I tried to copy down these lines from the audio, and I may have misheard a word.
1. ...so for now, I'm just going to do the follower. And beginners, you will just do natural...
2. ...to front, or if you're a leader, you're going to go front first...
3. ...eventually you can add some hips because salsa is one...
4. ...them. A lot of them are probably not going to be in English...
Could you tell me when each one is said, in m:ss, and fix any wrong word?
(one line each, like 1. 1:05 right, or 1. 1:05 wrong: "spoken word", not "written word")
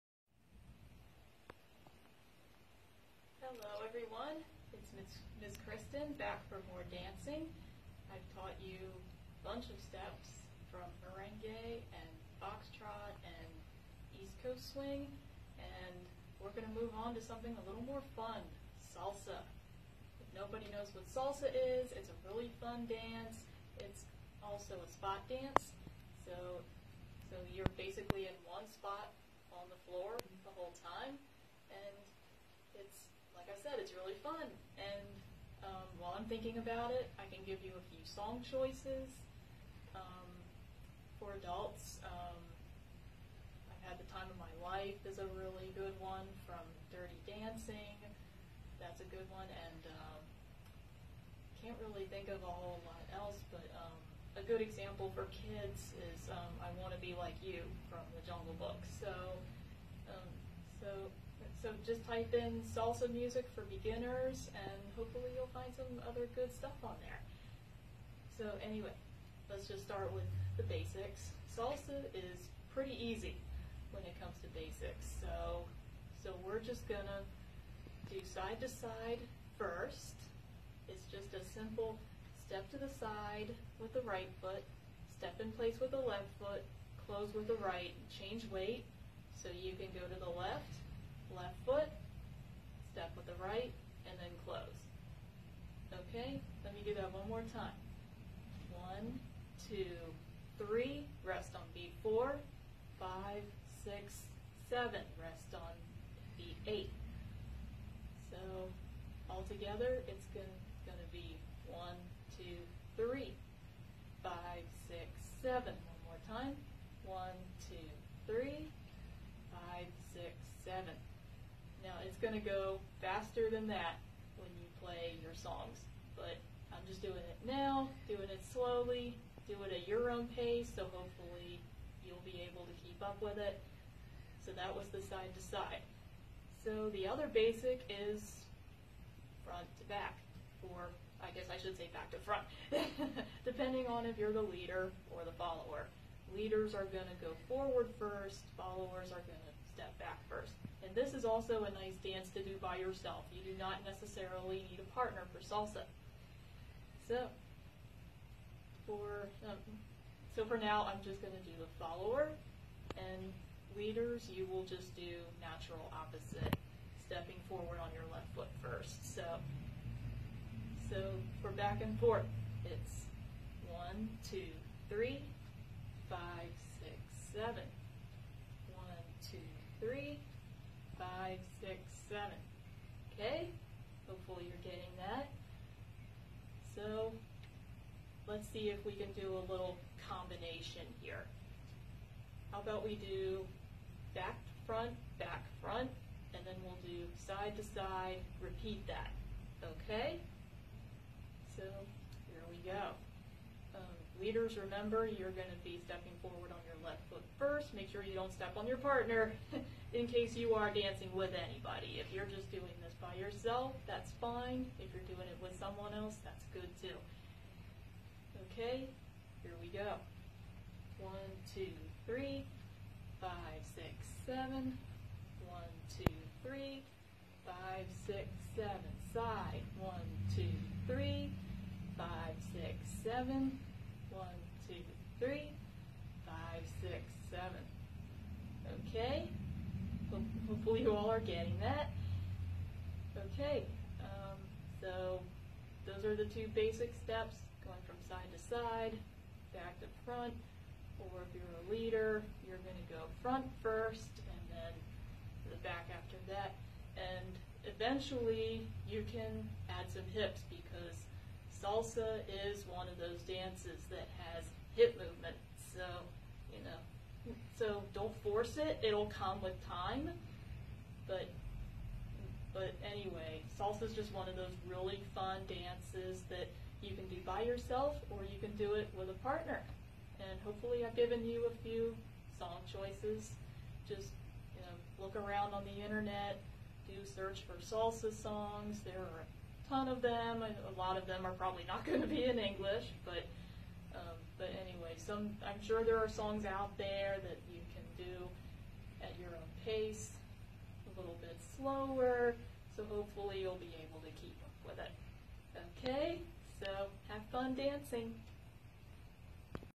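1. 2:40 wrong: "leaders", not "beginners"
2. 4:09 right
3. 4:17 right
4. 4:50 right.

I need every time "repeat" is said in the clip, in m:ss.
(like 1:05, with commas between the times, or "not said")
3:18.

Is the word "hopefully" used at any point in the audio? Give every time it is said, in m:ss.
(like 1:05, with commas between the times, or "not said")
1:04, 2:10, 3:04, 4:00, 4:40, 5:02.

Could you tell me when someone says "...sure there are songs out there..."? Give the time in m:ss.
4:55.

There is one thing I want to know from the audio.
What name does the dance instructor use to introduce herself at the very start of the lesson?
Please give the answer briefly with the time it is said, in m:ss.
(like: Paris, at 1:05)
Ms. Kristen, at 0:04.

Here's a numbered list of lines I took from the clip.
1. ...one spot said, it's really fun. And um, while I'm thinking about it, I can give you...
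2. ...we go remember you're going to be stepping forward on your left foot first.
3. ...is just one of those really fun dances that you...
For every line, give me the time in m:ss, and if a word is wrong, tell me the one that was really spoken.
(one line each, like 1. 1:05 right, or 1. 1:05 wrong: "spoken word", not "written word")
1. 0:28 right
2. 3:22 right
3. 4:33 right.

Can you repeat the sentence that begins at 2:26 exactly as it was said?
Leaders are going to go forward first, followers are going to step back first.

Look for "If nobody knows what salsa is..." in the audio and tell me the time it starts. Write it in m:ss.
0:20.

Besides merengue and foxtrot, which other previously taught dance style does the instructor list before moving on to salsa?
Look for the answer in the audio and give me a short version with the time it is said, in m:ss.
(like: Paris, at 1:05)
East Coast swing, at 0:14.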